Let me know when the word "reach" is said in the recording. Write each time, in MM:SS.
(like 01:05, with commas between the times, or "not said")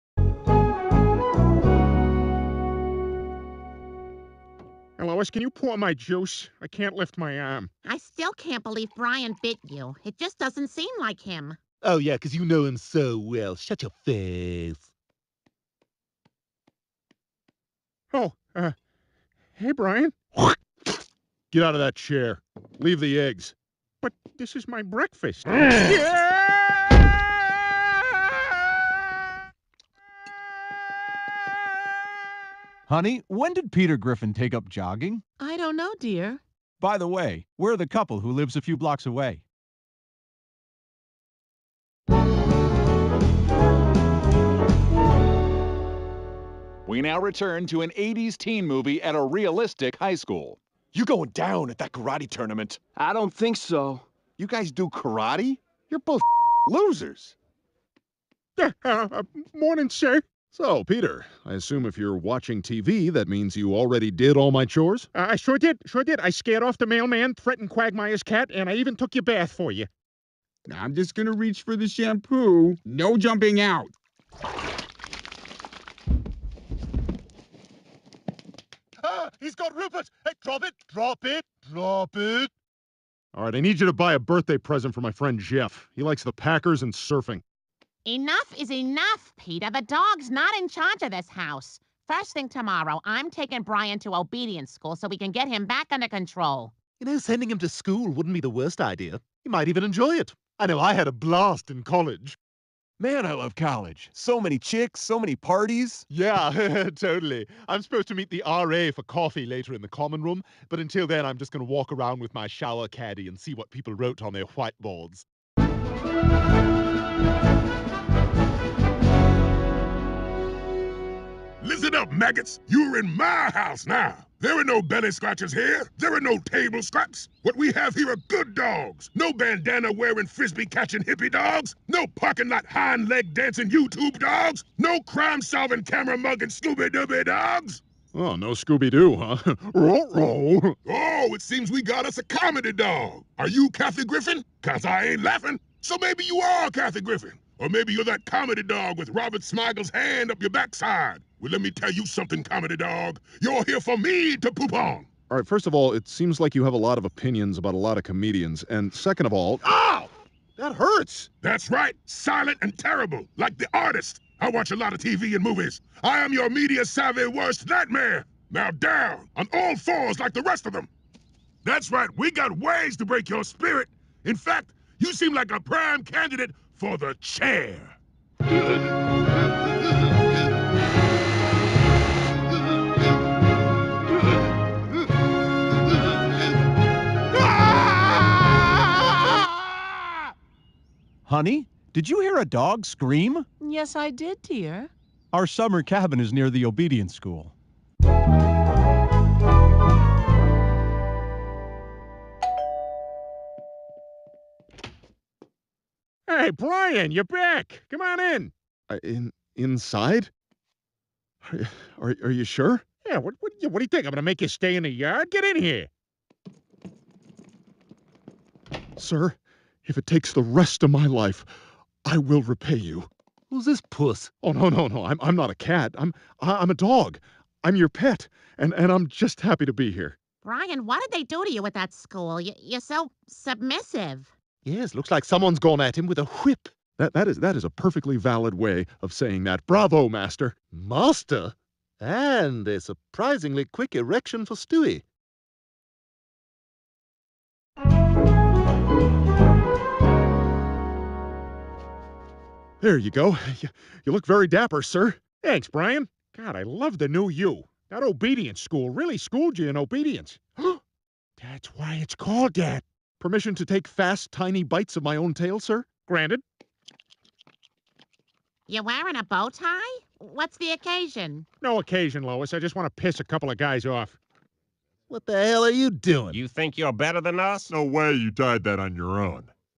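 01:11.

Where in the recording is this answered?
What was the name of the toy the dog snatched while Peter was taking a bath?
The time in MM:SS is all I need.
01:19.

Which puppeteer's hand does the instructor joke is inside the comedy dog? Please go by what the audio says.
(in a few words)
Robert Smigel.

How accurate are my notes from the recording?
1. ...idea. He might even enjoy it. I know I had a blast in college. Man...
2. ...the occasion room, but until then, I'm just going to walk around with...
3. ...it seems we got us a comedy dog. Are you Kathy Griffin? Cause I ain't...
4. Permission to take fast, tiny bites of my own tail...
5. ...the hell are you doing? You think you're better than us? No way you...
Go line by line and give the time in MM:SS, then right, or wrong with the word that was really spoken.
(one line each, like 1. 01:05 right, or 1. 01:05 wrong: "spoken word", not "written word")
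1. 01:38 right
2. 01:49 wrong: "common", not "occasion"
3. 02:21 right
4. 04:23 right
5. 04:35 right.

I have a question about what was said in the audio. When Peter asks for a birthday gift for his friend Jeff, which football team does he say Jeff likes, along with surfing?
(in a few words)
Packers.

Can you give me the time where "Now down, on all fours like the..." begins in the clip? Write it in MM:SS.
02:48.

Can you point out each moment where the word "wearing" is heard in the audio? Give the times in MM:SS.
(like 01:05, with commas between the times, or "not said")
02:09, 04:28.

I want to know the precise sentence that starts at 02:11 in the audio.
No parking lot hind leg dancing YouTube dogs.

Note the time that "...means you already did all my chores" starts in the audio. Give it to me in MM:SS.
01:03.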